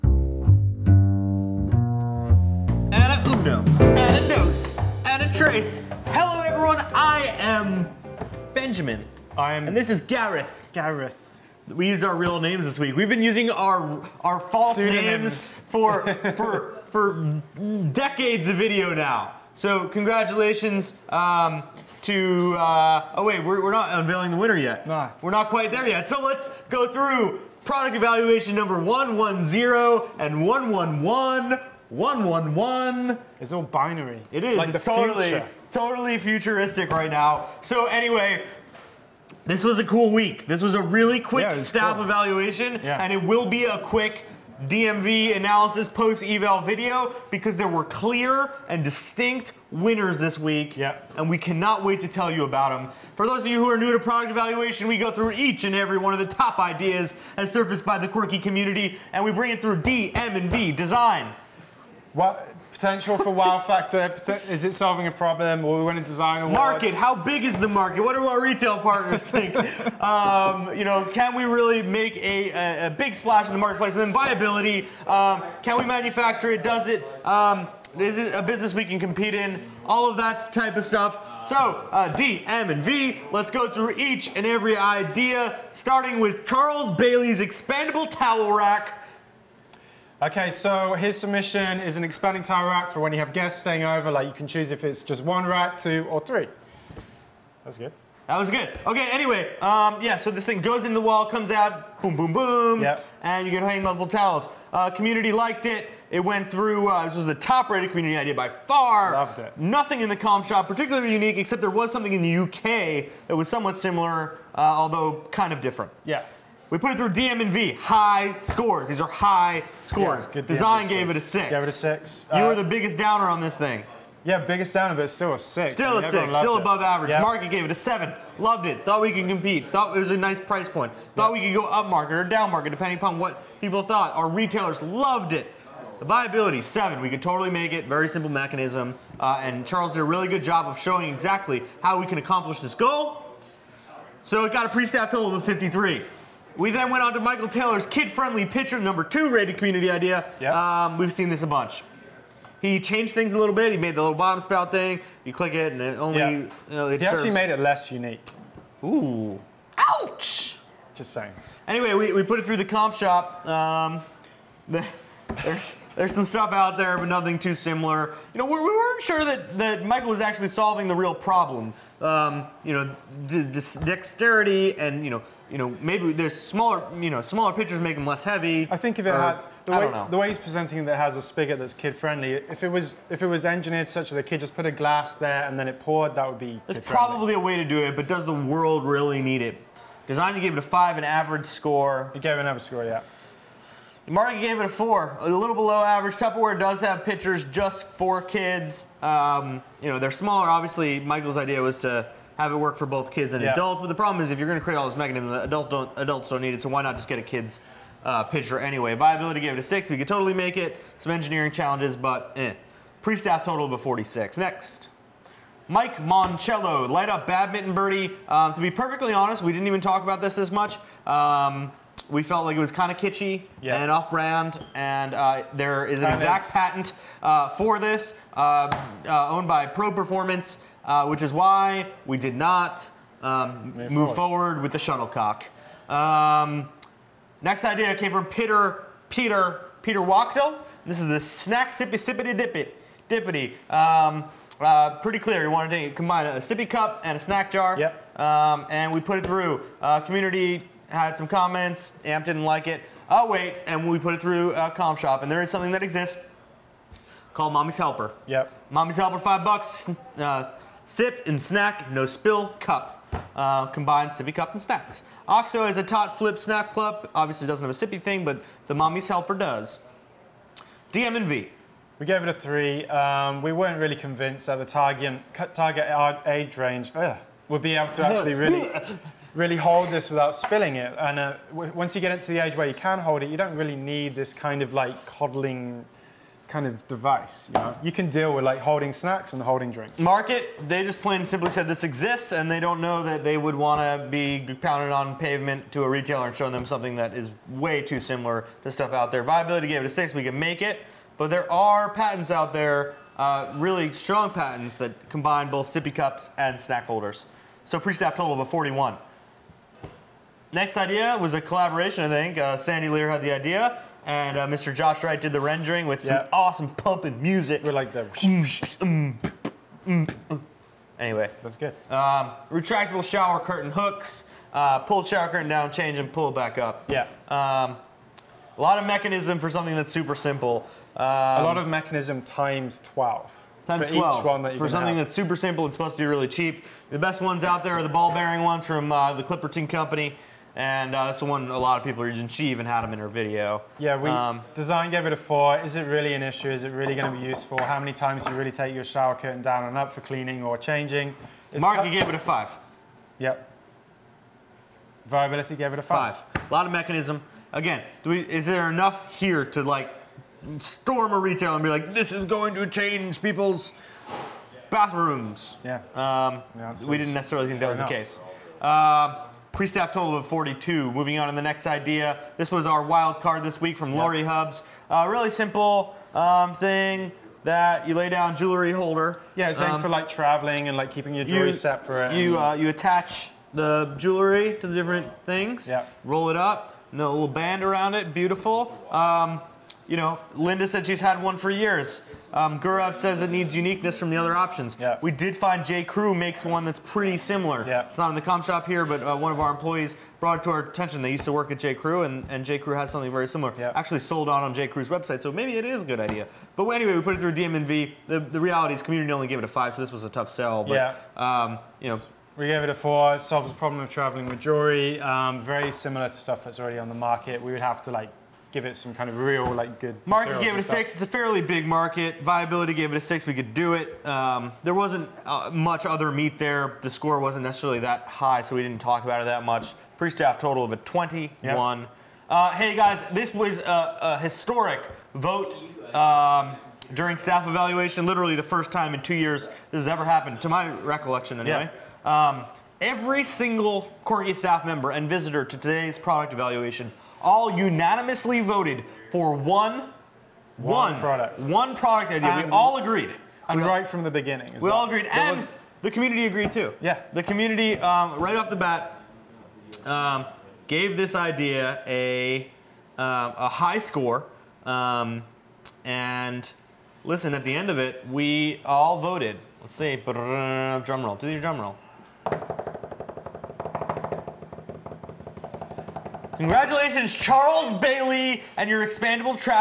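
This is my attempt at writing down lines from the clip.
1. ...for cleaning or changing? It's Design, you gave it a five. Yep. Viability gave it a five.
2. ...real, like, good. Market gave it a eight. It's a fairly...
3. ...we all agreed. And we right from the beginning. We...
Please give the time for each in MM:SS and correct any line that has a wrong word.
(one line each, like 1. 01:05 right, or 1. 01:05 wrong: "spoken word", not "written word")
1. 05:49 wrong: "Mark", not "Design"
2. 06:59 wrong: "six", not "eight"
3. 07:32 right.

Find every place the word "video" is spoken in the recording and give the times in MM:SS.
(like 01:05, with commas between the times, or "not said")
00:18, 00:46, 05:43.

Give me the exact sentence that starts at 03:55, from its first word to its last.
Um, next idea came from Peter Peter Peter Wachtel.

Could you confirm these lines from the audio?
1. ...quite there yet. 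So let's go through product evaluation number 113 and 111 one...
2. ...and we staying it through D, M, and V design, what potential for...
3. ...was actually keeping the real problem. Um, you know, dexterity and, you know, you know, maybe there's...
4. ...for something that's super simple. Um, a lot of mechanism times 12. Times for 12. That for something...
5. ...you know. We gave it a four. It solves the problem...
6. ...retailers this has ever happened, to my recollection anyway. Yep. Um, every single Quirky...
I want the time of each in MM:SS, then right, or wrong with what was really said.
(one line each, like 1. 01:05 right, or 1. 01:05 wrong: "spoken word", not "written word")
1. 00:25 wrong: "110", not "113"
2. 00:59 wrong: "bring", not "staying"
3. 02:50 wrong: "solving", not "keeping"
4. 05:29 right
5. 06:51 right
6. 07:19 wrong: "years", not "retailers".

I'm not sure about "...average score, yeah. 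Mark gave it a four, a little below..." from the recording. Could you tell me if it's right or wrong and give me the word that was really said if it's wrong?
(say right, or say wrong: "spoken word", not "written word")
right.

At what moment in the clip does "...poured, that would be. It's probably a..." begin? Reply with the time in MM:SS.
03:05.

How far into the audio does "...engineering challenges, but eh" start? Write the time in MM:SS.
03:31.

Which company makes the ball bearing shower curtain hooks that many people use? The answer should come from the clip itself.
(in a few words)
Clipperton Company.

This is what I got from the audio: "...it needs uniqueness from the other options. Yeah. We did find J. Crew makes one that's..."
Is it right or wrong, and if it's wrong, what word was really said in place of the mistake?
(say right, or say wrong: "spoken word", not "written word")
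right.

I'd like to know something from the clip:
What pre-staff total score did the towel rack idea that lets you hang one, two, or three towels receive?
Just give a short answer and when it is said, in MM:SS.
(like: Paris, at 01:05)
53, at 02:25.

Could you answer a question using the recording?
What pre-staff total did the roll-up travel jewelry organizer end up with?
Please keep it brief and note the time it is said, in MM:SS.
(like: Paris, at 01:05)
21, at 07:10.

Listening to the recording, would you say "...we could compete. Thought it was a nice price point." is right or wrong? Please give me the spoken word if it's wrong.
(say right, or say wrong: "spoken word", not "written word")
right.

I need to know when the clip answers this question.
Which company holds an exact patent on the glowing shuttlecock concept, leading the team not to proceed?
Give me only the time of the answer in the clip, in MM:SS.
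03:49.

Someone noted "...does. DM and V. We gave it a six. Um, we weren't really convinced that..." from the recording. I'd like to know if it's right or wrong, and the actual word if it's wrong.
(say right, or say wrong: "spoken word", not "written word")
wrong: "three", not "six".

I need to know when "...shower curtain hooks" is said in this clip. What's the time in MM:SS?
05:23.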